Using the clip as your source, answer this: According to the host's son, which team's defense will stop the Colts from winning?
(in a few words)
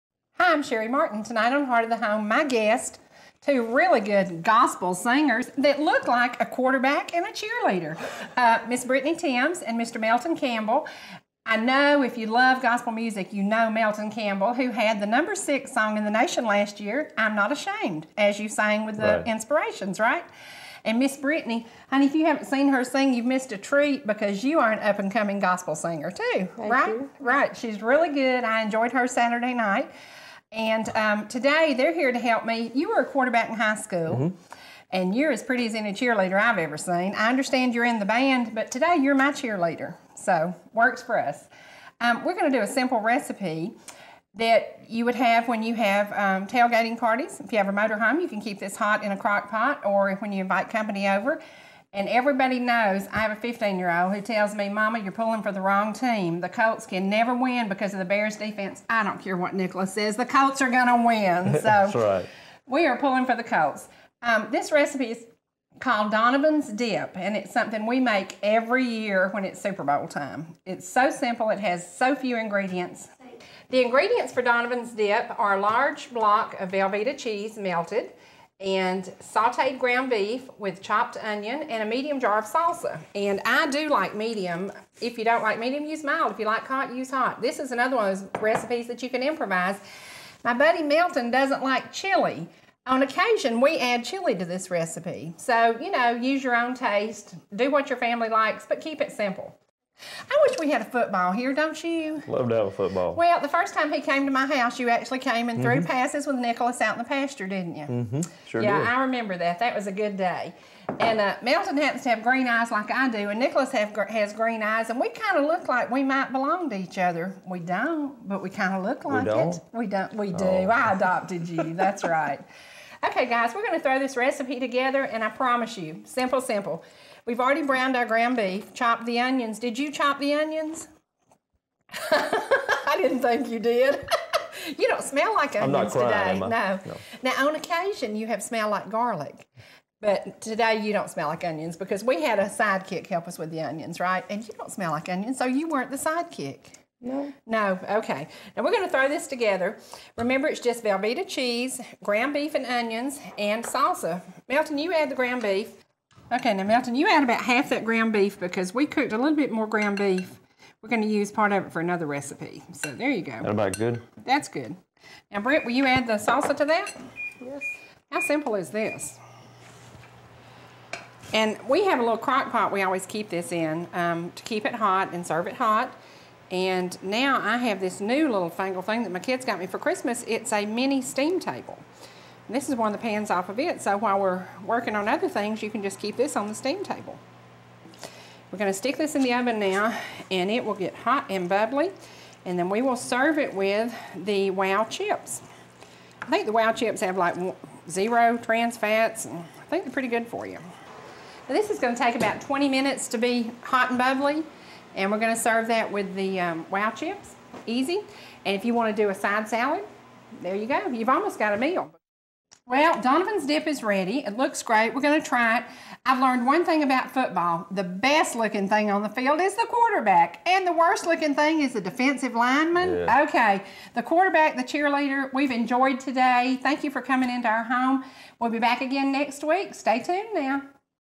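The Bears.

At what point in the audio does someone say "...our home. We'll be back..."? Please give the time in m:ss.
3:47.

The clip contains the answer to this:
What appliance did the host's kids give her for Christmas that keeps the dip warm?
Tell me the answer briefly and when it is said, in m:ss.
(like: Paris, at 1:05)
A mini steam table, at 3:00.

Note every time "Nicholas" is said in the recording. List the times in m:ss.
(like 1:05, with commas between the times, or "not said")
0:59, 1:46, 1:53.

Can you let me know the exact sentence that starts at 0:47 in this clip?
If you have a motorhome, you can keep this hot in a crock pot, or when you invite company over.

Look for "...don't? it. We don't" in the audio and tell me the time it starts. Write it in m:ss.
1:59.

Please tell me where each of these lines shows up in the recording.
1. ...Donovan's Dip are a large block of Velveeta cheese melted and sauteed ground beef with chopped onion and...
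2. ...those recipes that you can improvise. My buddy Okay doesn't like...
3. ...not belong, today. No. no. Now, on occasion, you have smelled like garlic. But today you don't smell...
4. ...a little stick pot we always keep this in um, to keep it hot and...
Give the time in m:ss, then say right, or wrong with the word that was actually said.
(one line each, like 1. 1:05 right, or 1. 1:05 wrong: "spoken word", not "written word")
1. 1:14 right
2. 1:28 wrong: "Melton", not "Okay"
3. 2:15 wrong: "crying", not "belong"
4. 2:51 wrong: "crock", not "stick".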